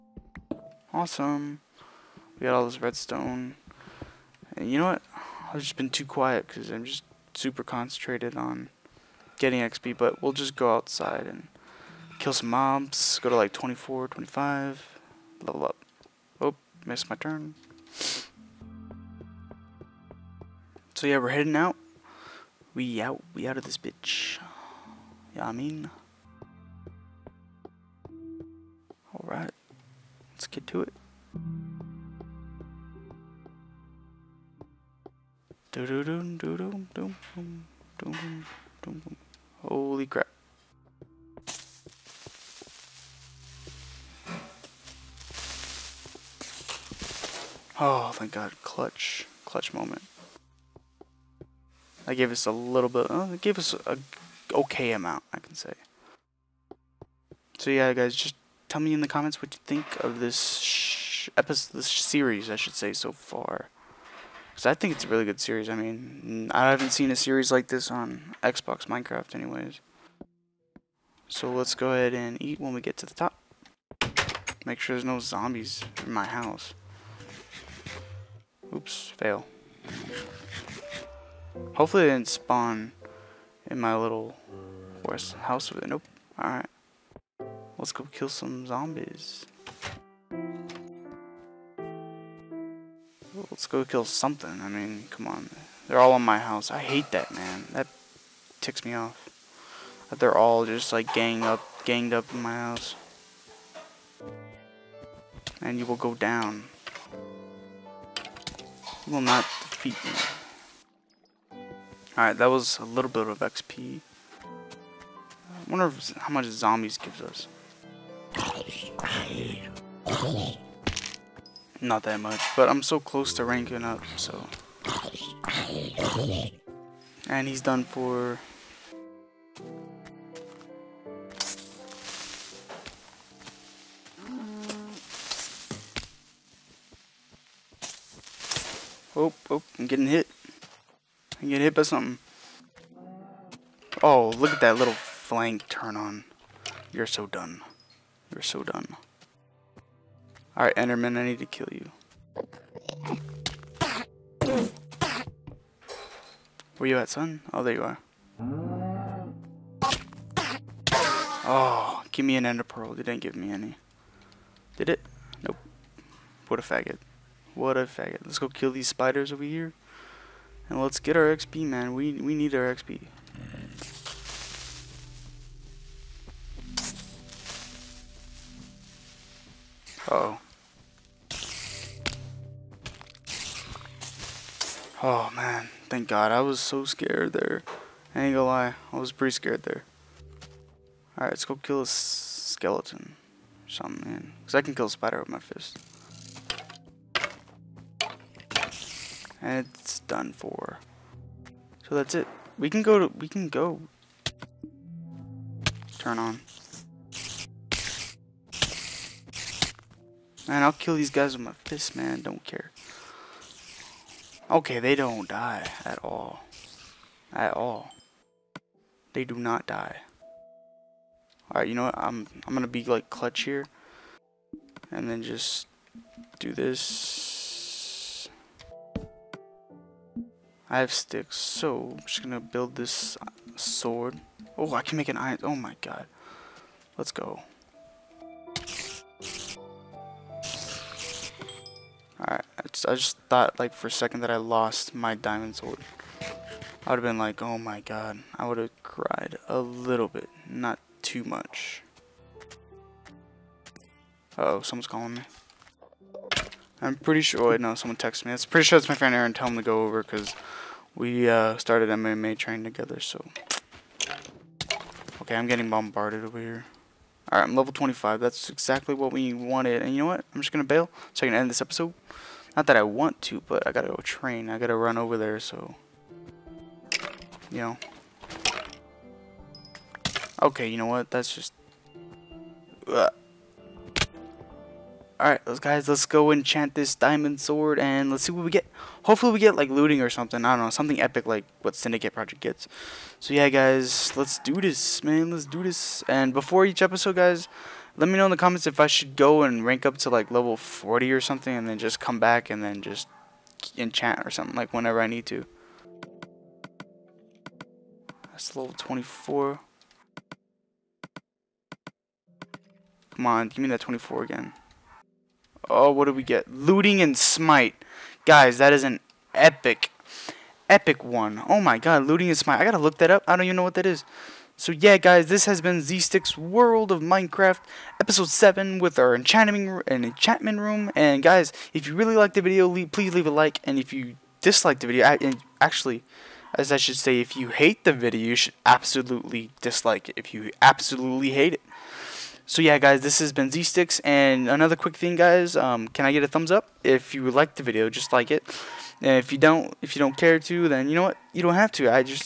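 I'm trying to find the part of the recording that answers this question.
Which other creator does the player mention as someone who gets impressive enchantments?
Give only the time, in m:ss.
4:51.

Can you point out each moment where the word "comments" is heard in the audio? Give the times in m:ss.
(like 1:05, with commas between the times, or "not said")
0:59, 4:58.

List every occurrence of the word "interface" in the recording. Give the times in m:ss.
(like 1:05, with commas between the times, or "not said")
not said.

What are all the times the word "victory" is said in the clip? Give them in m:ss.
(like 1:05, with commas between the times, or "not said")
not said.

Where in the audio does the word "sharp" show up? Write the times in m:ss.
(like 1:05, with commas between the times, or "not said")
not said.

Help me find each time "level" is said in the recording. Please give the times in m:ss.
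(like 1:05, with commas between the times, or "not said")
0:15, 4:27, 5:00, 5:08.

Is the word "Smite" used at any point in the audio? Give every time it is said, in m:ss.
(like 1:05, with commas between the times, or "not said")
5:17, 5:22.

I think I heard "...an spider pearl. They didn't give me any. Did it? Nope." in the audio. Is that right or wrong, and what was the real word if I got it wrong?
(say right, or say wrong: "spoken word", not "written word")
wrong: "ender", not "spider".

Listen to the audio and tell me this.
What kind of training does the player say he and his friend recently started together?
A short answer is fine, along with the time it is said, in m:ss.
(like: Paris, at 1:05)
MMA training, at 4:21.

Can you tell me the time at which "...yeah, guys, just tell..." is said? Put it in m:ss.
0:57.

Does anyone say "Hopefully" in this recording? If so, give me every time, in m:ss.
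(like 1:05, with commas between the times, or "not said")
1:21, 4:49.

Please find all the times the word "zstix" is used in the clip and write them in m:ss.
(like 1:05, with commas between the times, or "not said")
5:25, 5:43.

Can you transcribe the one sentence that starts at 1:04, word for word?
Because I think it's a really good series.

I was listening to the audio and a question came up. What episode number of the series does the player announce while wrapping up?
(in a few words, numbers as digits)
7.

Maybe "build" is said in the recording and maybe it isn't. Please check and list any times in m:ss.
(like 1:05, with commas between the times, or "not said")
3:52.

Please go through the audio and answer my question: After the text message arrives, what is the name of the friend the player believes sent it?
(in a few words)
Aaron.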